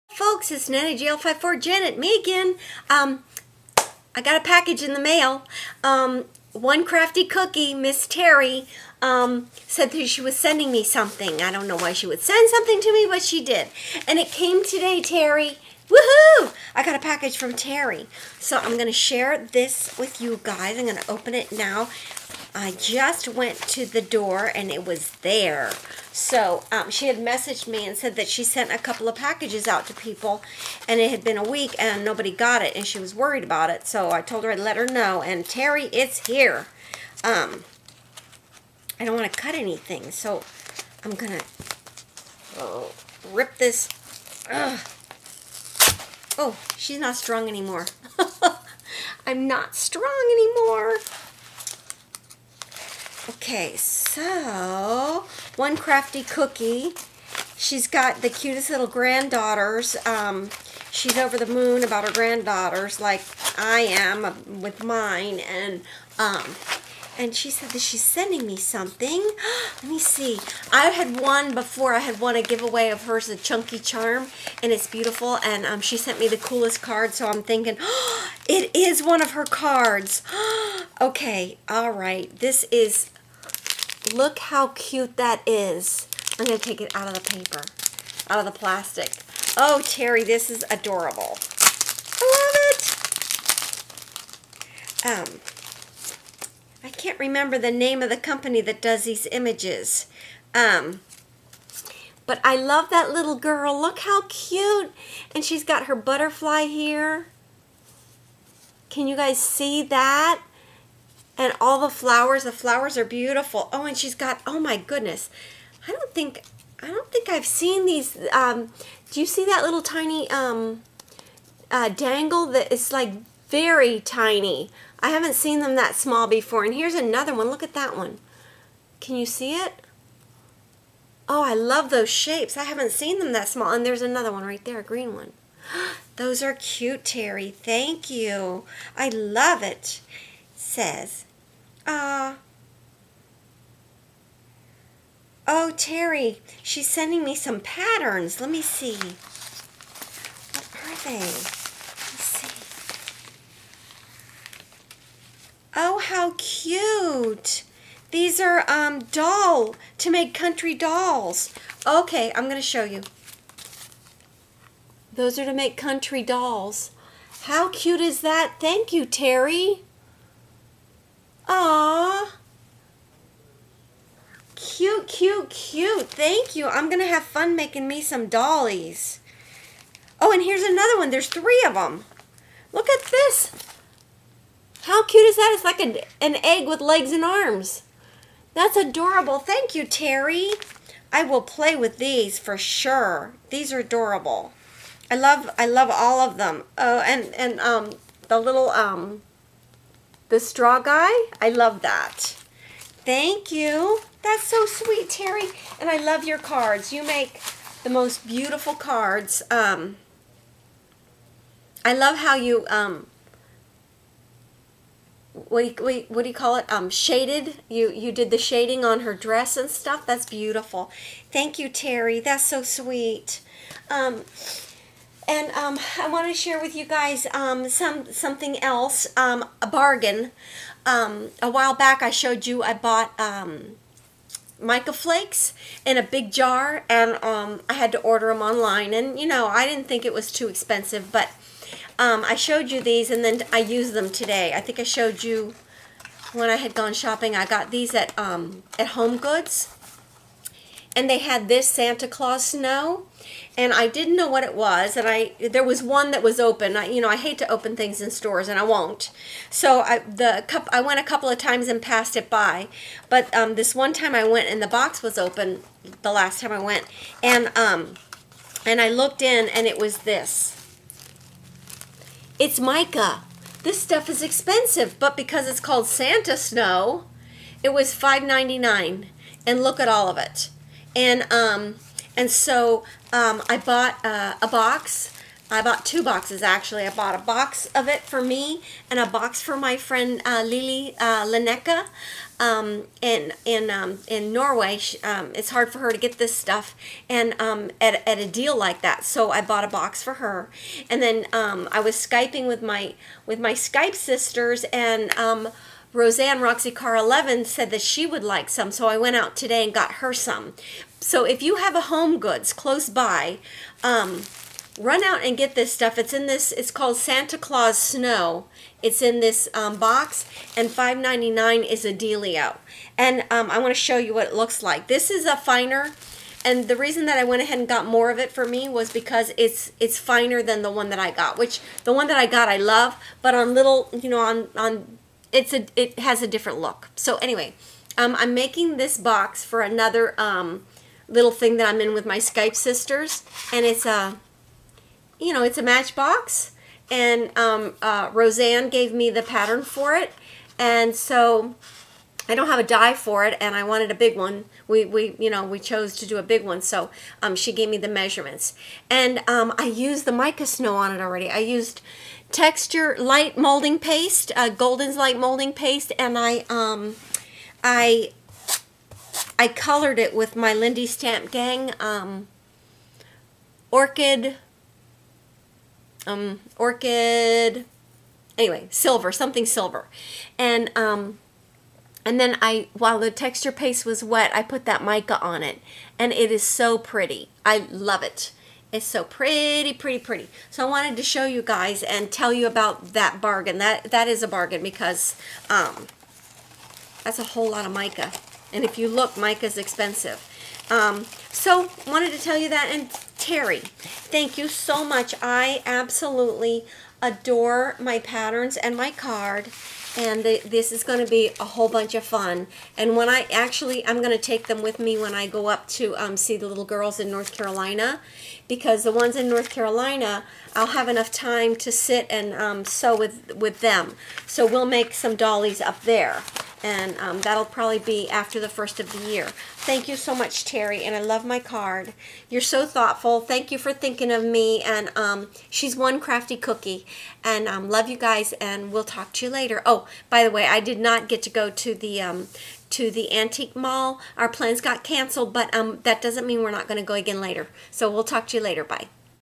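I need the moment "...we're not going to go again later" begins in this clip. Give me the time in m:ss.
7:26.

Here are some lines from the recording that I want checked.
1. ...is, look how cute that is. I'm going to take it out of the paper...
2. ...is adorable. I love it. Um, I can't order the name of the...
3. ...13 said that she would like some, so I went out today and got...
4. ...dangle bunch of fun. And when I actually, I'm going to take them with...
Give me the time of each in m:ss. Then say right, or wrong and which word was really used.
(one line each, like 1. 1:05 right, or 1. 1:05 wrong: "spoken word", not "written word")
1. 1:22 right
2. 1:30 wrong: "remember", not "order"
3. 5:06 wrong: "11", not "13"
4. 6:51 wrong: "whole", not "dangle".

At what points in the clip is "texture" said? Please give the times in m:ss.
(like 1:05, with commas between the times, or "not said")
6:02, 6:23.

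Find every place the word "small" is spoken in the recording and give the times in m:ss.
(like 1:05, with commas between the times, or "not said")
2:05, 2:13.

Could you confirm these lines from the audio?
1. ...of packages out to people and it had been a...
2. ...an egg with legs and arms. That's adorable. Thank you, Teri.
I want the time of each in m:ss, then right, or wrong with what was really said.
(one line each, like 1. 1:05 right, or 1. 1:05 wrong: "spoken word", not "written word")
1. 0:29 right
2. 3:06 right.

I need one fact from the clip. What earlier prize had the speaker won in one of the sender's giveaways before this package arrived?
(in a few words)
Chunky Charm.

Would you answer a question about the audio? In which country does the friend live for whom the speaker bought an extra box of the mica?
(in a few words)
Norway.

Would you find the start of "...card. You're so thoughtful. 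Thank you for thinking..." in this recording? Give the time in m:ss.
7:11.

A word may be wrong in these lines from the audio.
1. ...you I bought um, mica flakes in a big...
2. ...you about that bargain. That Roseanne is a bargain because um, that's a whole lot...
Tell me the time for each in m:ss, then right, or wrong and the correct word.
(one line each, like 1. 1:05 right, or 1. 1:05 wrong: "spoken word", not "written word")
1. 3:52 right
2. 6:32 wrong: "That", not "Roseanne".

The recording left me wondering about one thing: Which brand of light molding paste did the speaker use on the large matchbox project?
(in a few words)
Golden.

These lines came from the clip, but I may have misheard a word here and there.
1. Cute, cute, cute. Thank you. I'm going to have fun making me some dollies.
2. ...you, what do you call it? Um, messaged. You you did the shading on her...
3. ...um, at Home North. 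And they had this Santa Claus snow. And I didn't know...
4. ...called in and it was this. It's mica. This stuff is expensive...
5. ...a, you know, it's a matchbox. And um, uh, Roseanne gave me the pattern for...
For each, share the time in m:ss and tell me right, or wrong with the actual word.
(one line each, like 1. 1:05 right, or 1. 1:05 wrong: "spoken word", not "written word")
1. 2:54 right
2. 3:35 wrong: "shaded", not "messaged"
3. 4:08 wrong: "Goods", not "North"
4. 4:28 wrong: "looked", not "called"
5. 5:43 right.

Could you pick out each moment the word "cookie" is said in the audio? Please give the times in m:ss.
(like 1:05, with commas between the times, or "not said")
0:07, 0:56, 7:16.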